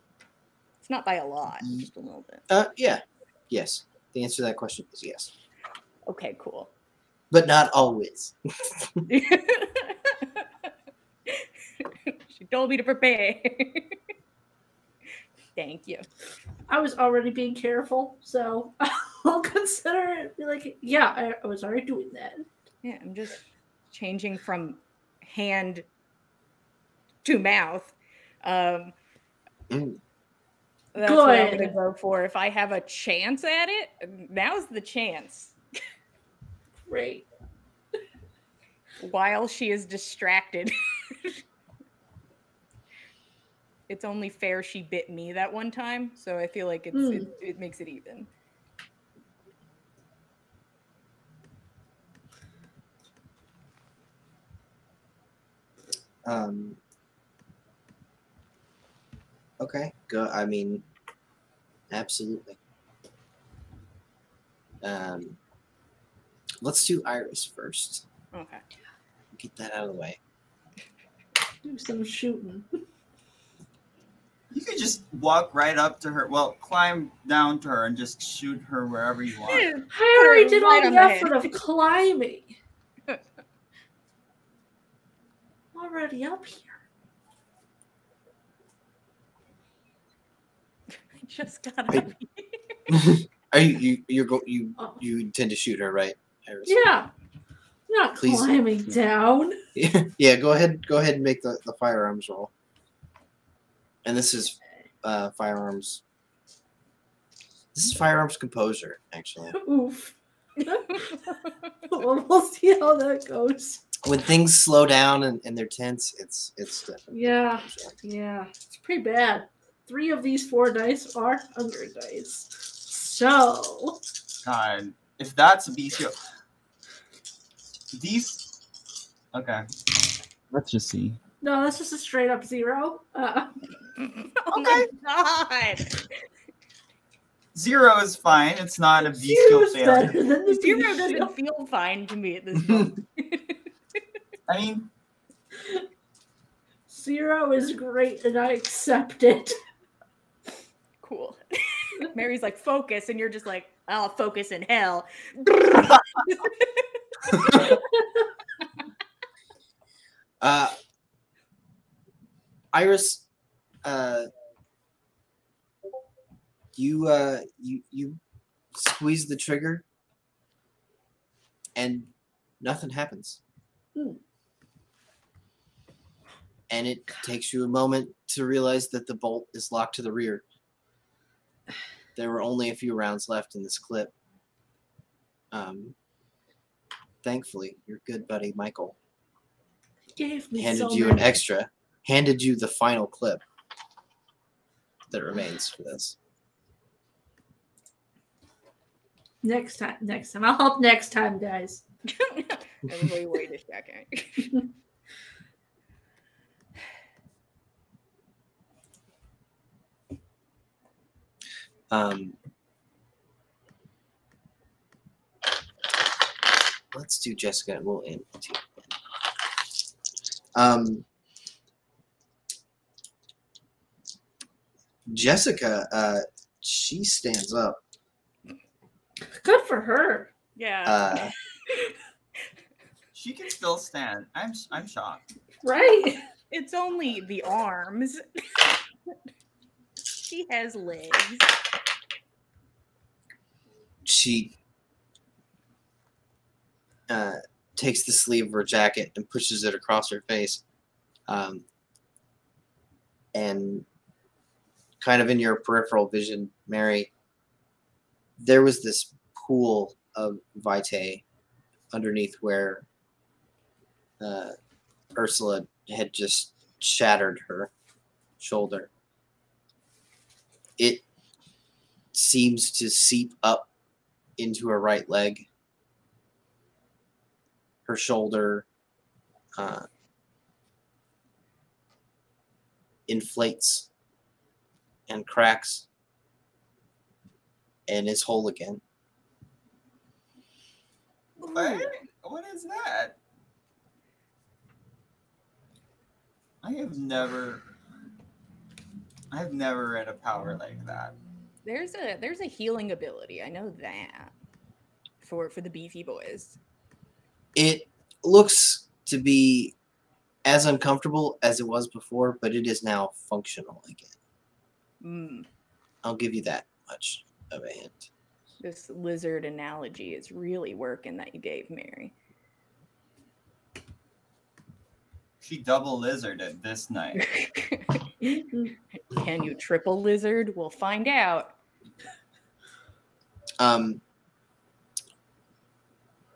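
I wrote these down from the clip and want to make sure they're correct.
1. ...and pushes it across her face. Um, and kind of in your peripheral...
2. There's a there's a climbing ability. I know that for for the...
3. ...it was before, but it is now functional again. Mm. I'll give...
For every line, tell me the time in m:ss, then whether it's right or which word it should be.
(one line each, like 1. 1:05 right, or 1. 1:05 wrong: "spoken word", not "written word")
1. 4:09 right
2. 5:01 wrong: "healing", not "climbing"
3. 5:11 right.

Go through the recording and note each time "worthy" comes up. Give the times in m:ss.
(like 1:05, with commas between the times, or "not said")
not said.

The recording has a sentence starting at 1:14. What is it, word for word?
You could just walk right up to her.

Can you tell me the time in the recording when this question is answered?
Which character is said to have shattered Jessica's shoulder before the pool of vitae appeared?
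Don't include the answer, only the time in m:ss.
4:25.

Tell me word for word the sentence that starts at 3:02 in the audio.
There were only a few rounds left in this clip.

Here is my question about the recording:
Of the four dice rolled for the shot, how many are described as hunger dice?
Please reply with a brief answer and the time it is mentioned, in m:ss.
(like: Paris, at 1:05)
Three, at 1:59.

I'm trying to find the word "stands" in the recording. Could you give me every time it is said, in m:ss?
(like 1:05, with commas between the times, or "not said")
3:47, 3:53.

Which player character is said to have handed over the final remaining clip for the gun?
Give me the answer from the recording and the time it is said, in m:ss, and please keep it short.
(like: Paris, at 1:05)
Michael, at 3:08.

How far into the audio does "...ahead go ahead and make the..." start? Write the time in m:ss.
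1:40.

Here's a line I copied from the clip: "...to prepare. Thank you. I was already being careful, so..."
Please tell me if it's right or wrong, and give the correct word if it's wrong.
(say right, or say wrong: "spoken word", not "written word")
right.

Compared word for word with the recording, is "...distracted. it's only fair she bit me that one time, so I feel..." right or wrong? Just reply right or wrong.
right.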